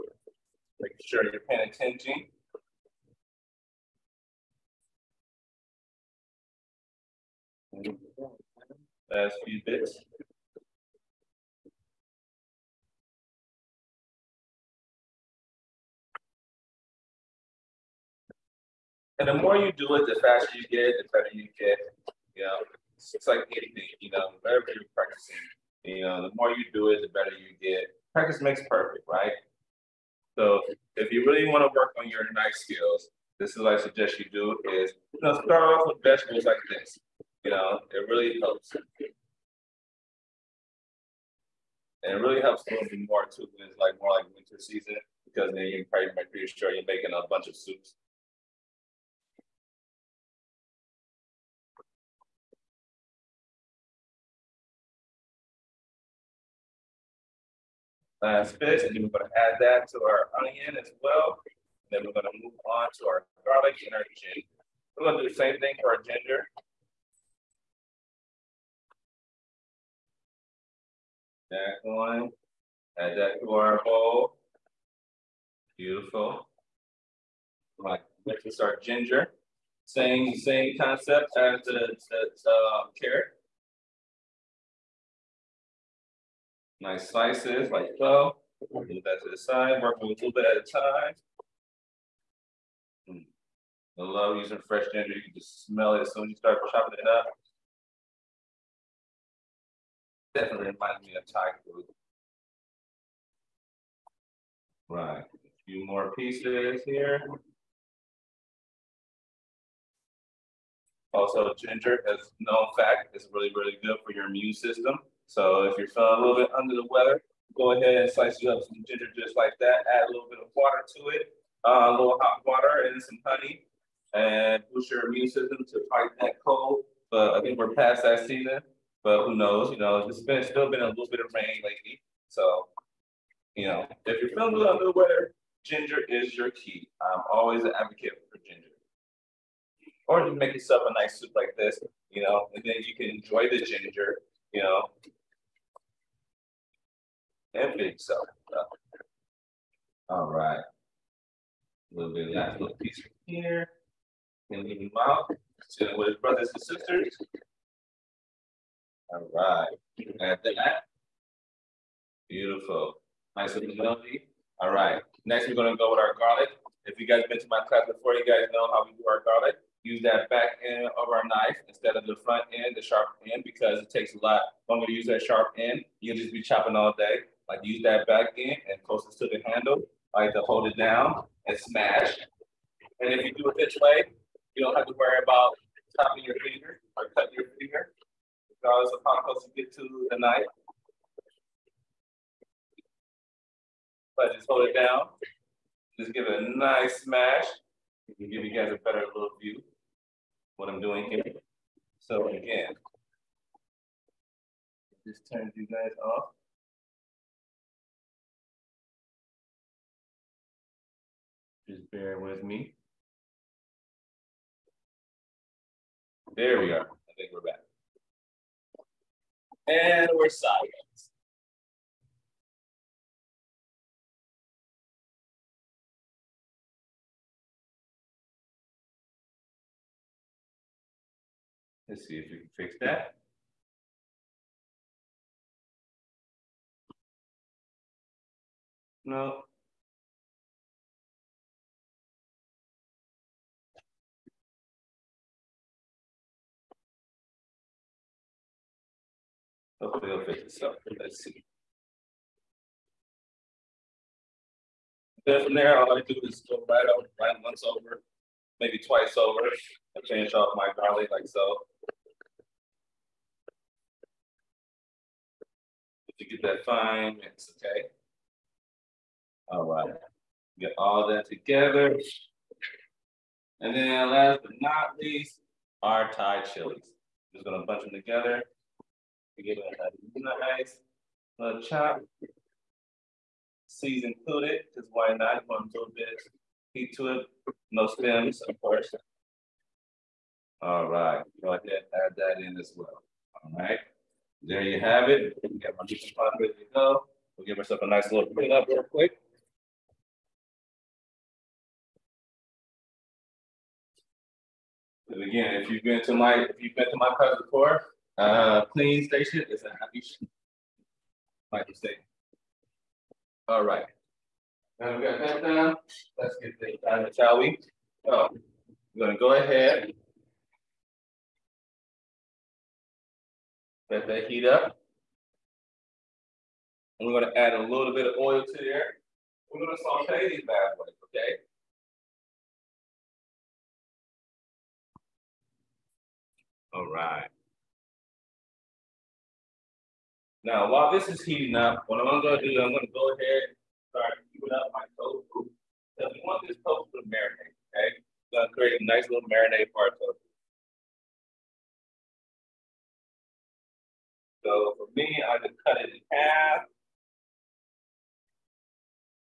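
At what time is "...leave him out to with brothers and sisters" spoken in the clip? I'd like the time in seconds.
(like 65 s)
154 s.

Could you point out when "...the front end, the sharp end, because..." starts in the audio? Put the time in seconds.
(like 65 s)
172 s.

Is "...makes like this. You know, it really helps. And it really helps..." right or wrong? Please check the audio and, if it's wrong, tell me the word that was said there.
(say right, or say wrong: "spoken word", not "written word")
wrong: "vegetables", not "makes".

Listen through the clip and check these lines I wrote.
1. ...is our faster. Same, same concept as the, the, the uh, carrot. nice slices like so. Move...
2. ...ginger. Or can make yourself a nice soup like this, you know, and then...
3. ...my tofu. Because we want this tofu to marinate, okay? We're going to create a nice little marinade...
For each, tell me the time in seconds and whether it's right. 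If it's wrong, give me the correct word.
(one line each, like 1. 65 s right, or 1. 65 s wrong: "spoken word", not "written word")
1. 78 s wrong: "ginger", not "faster"
2. 138 s right
3. 344 s right.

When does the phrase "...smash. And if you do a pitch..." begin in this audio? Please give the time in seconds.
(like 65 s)
181 s.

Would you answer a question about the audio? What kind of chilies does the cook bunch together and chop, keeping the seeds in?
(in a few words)
Thai chilies.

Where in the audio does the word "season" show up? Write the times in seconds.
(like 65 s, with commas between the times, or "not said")
44 s, 128 s.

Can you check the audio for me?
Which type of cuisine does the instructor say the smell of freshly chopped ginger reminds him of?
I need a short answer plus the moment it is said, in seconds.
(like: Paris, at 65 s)
Thai food, at 101 s.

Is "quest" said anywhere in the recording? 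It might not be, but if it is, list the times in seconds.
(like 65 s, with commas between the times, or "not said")
not said.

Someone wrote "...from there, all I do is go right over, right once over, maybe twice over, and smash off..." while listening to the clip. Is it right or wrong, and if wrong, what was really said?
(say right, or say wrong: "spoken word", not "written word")
wrong: "finish", not "smash".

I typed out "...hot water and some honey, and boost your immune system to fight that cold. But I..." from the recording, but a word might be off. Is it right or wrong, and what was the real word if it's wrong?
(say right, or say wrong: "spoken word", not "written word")
right.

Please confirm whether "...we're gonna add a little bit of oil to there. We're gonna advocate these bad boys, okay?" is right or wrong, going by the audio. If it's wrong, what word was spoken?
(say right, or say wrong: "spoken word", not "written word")
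wrong: "saute", not "advocate".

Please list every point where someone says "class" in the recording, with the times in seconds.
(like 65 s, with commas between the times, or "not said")
167 s, 307 s.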